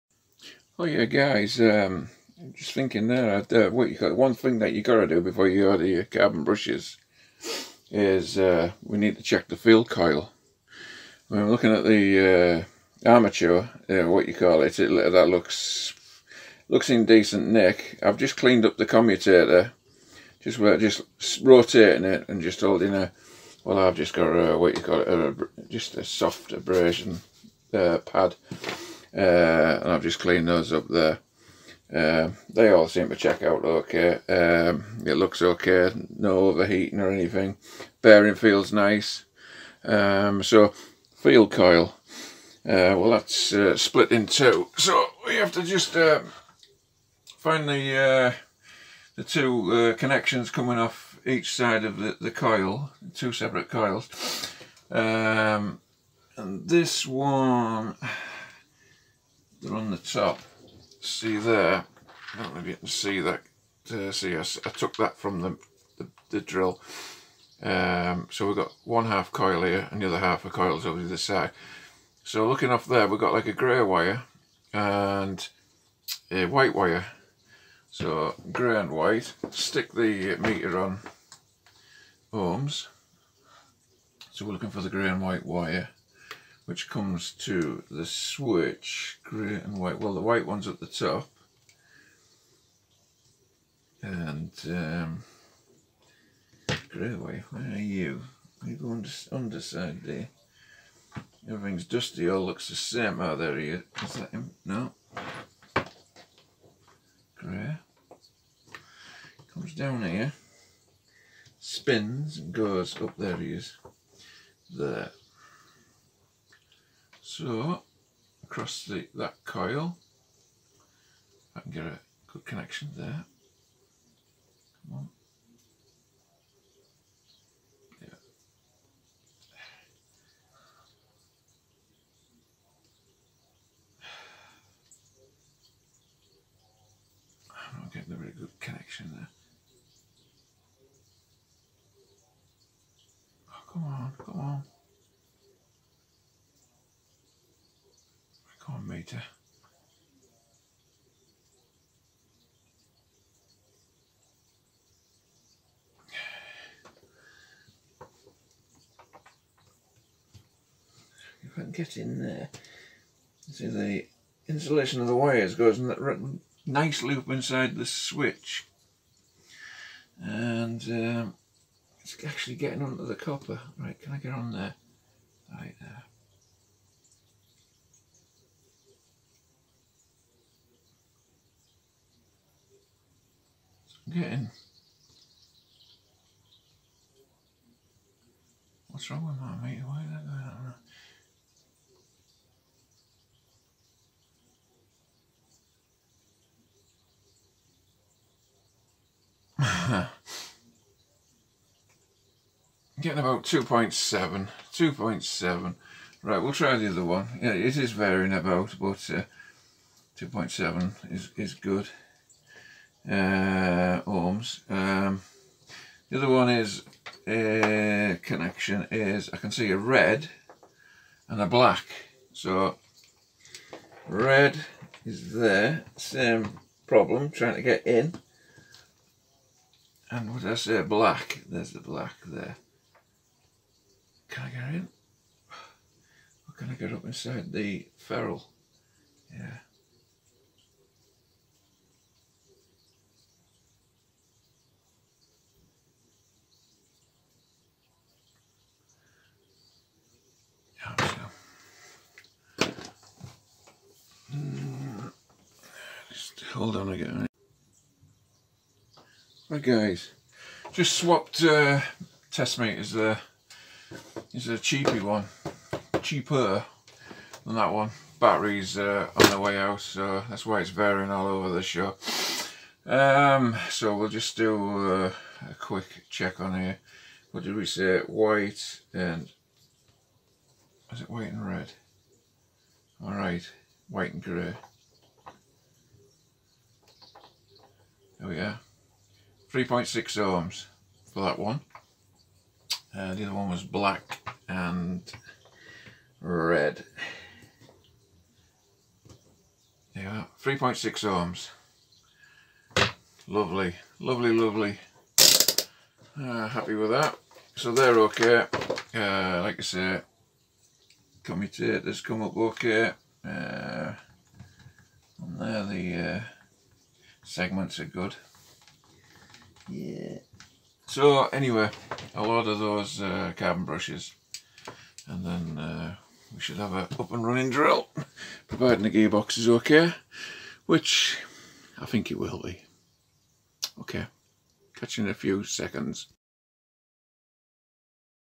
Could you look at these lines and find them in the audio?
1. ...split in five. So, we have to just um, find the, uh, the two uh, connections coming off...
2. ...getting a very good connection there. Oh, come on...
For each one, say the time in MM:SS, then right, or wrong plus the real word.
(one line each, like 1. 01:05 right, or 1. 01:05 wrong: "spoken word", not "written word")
1. 00:43 wrong: "two", not "five"
2. 02:17 right.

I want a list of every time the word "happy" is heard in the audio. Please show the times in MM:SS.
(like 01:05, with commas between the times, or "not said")
05:06.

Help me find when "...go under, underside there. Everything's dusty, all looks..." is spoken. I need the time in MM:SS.
01:38.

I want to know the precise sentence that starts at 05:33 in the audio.
Okay, catch you in a few seconds.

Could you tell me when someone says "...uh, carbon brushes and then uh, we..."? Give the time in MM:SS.
05:23.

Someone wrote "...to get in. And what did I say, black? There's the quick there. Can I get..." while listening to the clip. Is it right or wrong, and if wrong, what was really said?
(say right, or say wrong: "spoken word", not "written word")
wrong: "black", not "quick".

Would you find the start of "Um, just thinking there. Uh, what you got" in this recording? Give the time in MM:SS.
00:01.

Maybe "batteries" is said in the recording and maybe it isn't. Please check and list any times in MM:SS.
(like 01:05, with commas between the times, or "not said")
04:28.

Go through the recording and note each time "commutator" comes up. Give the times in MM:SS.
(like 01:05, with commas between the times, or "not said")
00:18, 05:11.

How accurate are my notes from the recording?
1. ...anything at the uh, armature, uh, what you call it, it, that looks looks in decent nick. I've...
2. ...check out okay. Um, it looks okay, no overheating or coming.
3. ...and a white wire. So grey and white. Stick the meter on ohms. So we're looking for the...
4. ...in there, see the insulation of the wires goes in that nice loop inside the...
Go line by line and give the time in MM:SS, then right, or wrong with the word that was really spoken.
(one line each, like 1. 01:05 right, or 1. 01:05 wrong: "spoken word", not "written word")
1. 00:11 wrong: "looking", not "anything"
2. 00:33 wrong: "anything", not "coming"
3. 01:14 right
4. 02:41 right.